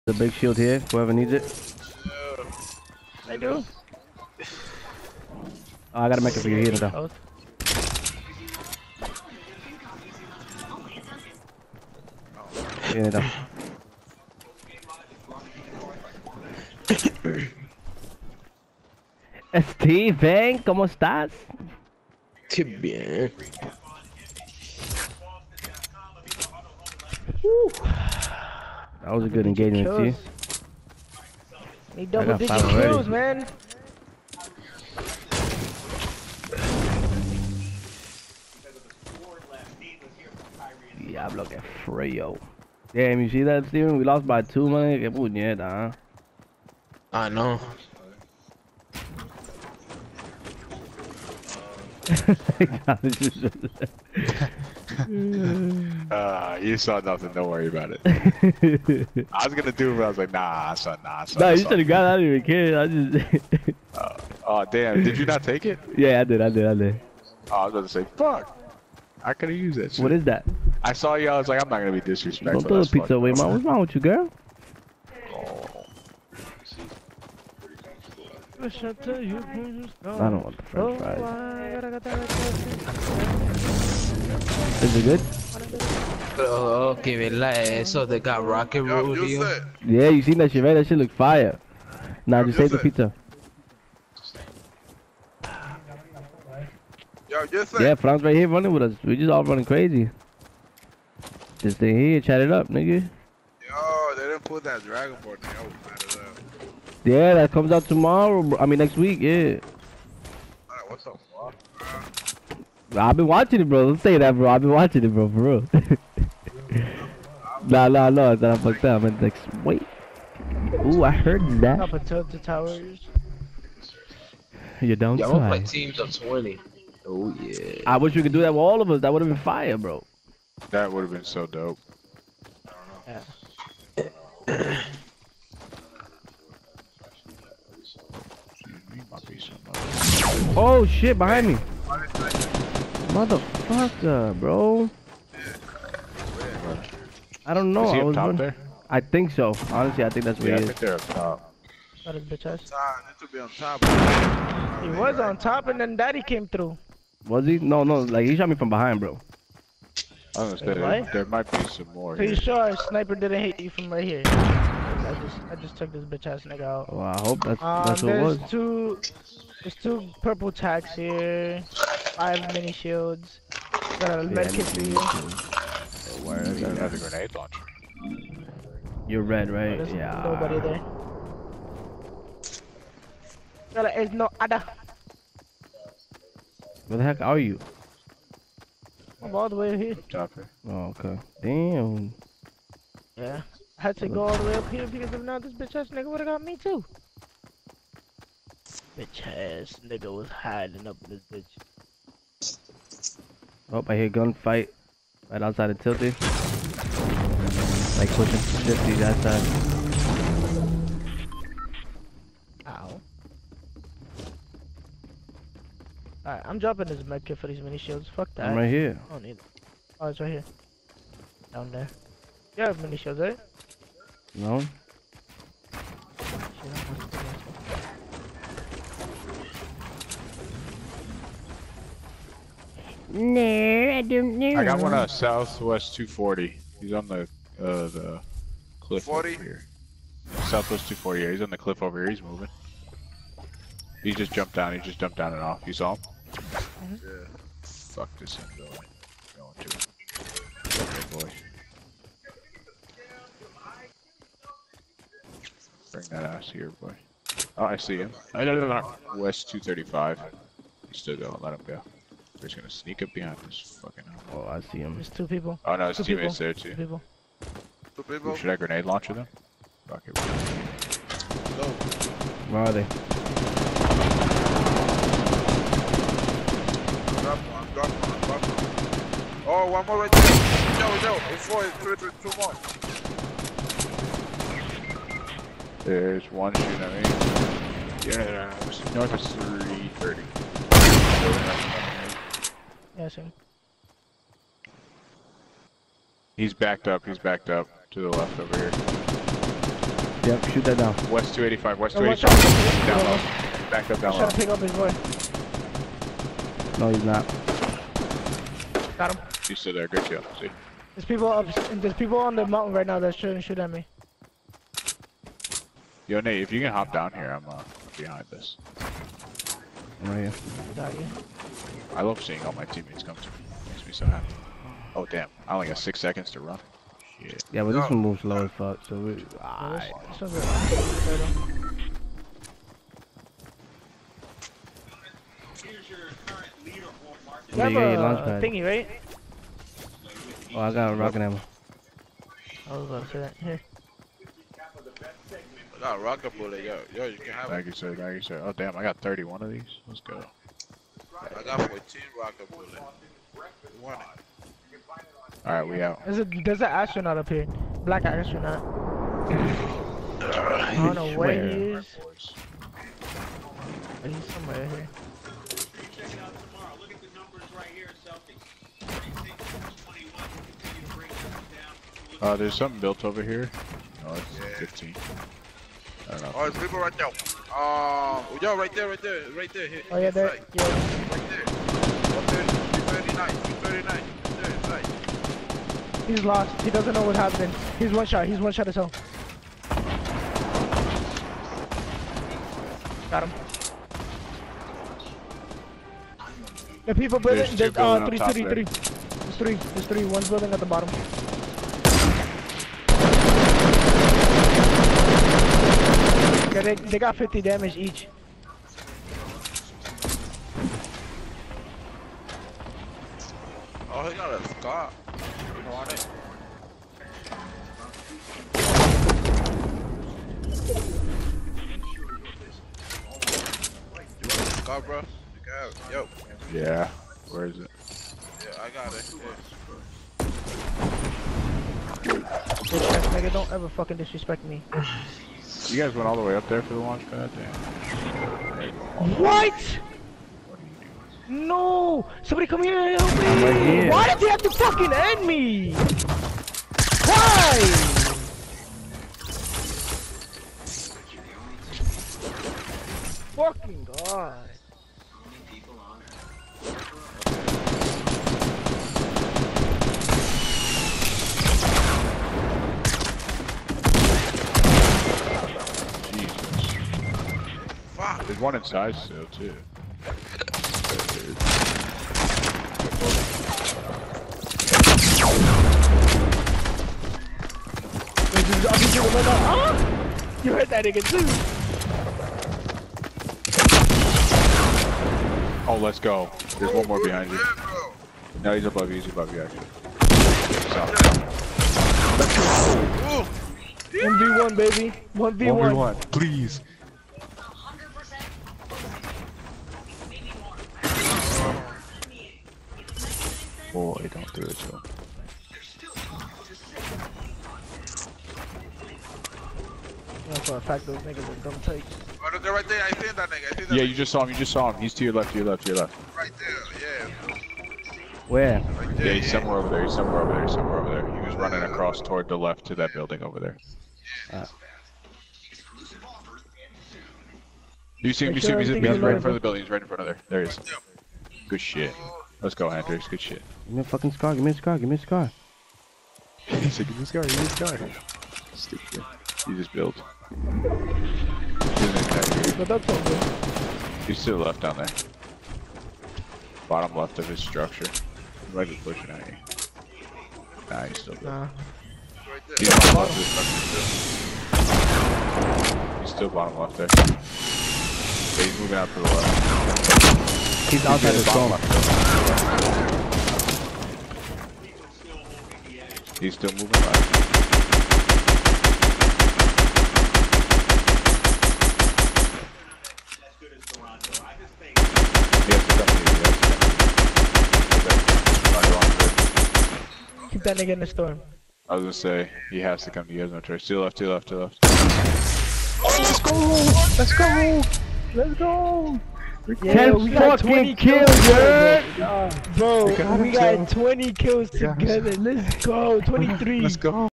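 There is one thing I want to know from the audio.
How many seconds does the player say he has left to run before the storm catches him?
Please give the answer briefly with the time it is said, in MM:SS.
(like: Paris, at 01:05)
6, at 05:25.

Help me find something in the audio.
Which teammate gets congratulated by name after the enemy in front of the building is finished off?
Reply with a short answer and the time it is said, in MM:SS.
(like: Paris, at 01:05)
Hendrix, at 08:52.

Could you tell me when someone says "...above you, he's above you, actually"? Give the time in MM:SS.
08:08.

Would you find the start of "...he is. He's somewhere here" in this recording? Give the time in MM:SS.
06:01.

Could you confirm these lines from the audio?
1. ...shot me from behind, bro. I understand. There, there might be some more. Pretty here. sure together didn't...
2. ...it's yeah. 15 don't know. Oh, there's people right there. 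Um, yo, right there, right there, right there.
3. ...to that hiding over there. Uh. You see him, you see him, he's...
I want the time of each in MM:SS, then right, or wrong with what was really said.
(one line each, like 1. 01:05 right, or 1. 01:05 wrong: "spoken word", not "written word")
1. 02:38 wrong: "sniper", not "together"
2. 06:14 right
3. 08:42 wrong: "building", not "hiding".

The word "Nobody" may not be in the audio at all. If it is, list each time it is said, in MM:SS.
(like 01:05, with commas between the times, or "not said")
03:00.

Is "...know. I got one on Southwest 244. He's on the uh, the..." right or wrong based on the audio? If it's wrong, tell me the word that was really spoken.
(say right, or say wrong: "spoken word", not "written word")
wrong: "240", not "244".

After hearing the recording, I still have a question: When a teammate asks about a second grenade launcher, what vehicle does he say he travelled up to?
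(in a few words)
Chopper.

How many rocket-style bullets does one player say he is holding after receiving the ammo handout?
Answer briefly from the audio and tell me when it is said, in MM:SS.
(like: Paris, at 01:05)
14, at 05:51.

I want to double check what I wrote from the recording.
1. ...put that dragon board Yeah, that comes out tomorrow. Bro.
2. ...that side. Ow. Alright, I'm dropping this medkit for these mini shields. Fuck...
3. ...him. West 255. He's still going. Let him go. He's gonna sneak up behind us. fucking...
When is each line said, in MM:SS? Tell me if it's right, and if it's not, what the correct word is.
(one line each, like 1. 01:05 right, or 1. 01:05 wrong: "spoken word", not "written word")
1. 01:44 right
2. 03:28 right
3. 04:17 wrong: "235", not "255".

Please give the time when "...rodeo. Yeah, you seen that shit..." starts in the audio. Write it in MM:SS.
01:28.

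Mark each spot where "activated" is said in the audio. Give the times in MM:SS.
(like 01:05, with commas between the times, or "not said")
not said.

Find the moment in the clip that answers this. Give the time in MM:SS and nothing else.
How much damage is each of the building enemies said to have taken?
06:47.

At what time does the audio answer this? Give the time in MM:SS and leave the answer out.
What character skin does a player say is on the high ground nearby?
05:57.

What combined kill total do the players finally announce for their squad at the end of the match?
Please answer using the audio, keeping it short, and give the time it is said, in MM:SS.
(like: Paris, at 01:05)
23, at 09:56.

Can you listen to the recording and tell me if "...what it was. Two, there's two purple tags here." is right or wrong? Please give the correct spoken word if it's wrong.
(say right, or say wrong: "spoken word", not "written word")
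right.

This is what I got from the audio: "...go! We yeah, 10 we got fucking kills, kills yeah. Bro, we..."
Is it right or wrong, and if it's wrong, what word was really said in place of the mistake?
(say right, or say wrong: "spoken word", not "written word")
right.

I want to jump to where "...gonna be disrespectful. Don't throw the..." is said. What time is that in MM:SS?
01:11.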